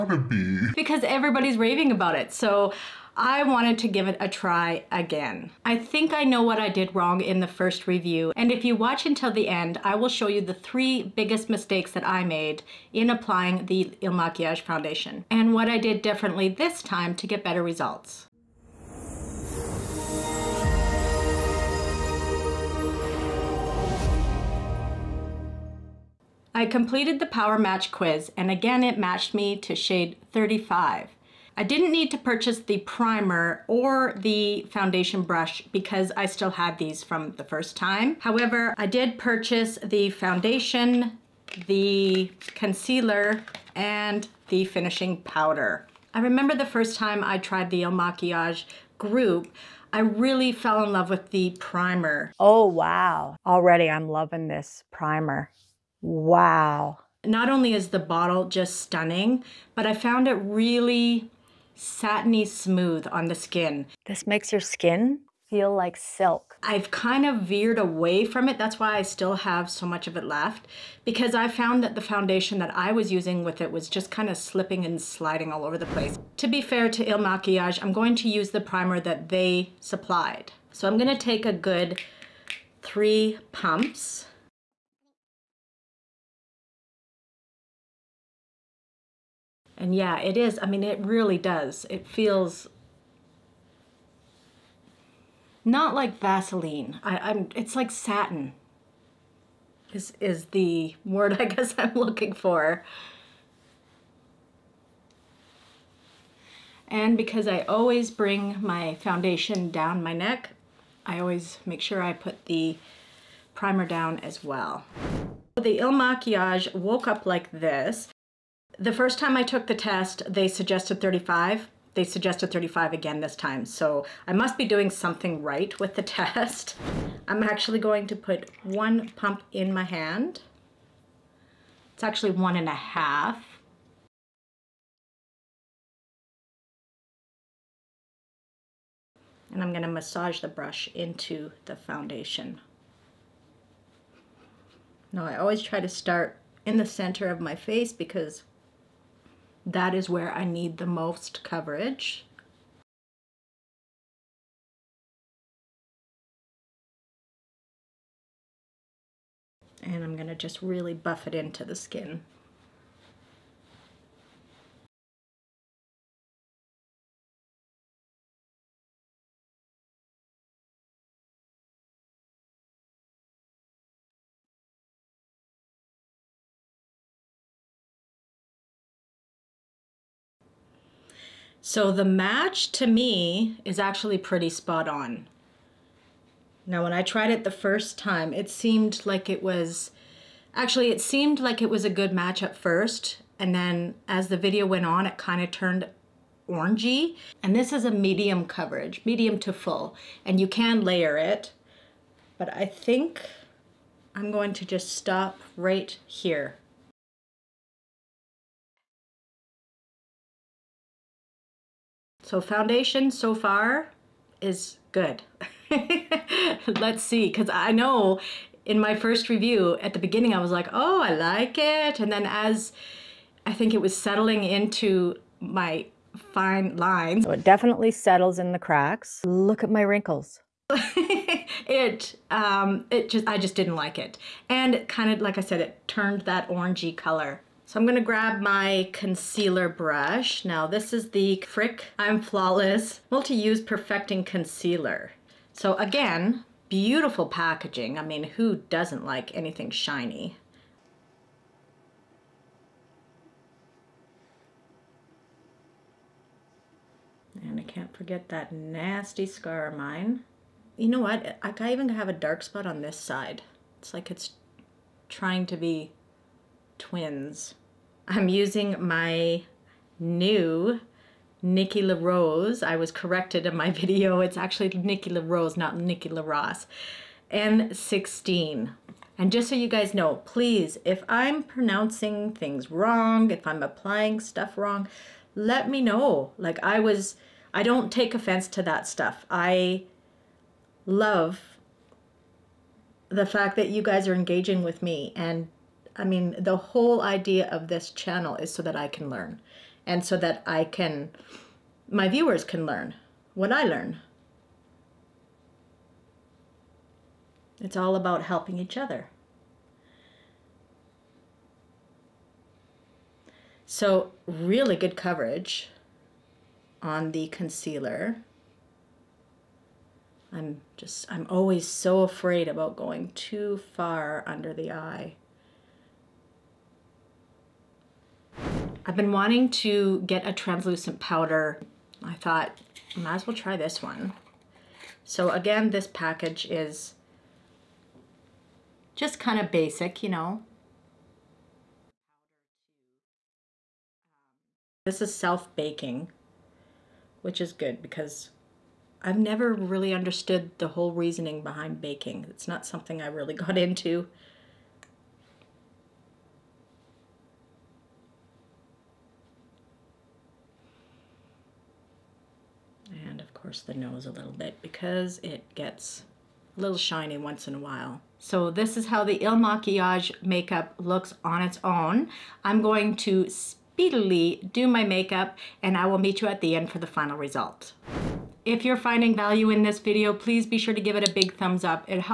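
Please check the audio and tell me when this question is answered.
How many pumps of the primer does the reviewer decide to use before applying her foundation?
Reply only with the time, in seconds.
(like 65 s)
82 s.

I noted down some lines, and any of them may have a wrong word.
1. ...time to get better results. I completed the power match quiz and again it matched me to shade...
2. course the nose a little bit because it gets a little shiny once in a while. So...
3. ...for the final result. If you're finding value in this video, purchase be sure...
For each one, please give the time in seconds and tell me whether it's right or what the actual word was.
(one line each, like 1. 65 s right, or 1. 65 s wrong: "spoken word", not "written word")
1. 16 s right
2. 363 s right
3. 376 s wrong: "please", not "purchase".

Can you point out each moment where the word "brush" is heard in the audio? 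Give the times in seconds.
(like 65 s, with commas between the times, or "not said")
35 s, 140 s, 239 s.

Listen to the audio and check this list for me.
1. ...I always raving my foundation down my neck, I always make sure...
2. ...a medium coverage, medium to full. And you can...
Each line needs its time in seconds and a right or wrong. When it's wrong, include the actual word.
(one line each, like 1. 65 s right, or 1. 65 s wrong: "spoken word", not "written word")
1. 107 s wrong: "bring", not "raving"
2. 197 s right.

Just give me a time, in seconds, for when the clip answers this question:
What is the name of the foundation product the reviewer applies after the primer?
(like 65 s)
116 s.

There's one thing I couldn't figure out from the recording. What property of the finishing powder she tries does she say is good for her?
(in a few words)
self-baking.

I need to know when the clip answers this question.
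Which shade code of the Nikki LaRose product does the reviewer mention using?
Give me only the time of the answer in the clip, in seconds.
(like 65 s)
277 s.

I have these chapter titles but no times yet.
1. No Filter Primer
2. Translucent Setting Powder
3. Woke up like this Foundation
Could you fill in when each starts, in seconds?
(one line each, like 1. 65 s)
1. 76 s
2. 336 s
3. 118 s.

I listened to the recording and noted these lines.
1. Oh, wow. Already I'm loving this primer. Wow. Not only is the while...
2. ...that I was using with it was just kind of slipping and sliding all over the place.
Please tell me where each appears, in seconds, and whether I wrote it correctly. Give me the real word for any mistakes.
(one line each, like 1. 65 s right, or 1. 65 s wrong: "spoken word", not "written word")
1. 52 s wrong: "bottle", not "while"
2. 72 s right.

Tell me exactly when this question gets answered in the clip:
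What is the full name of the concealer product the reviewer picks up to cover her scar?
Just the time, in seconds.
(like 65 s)
243 s.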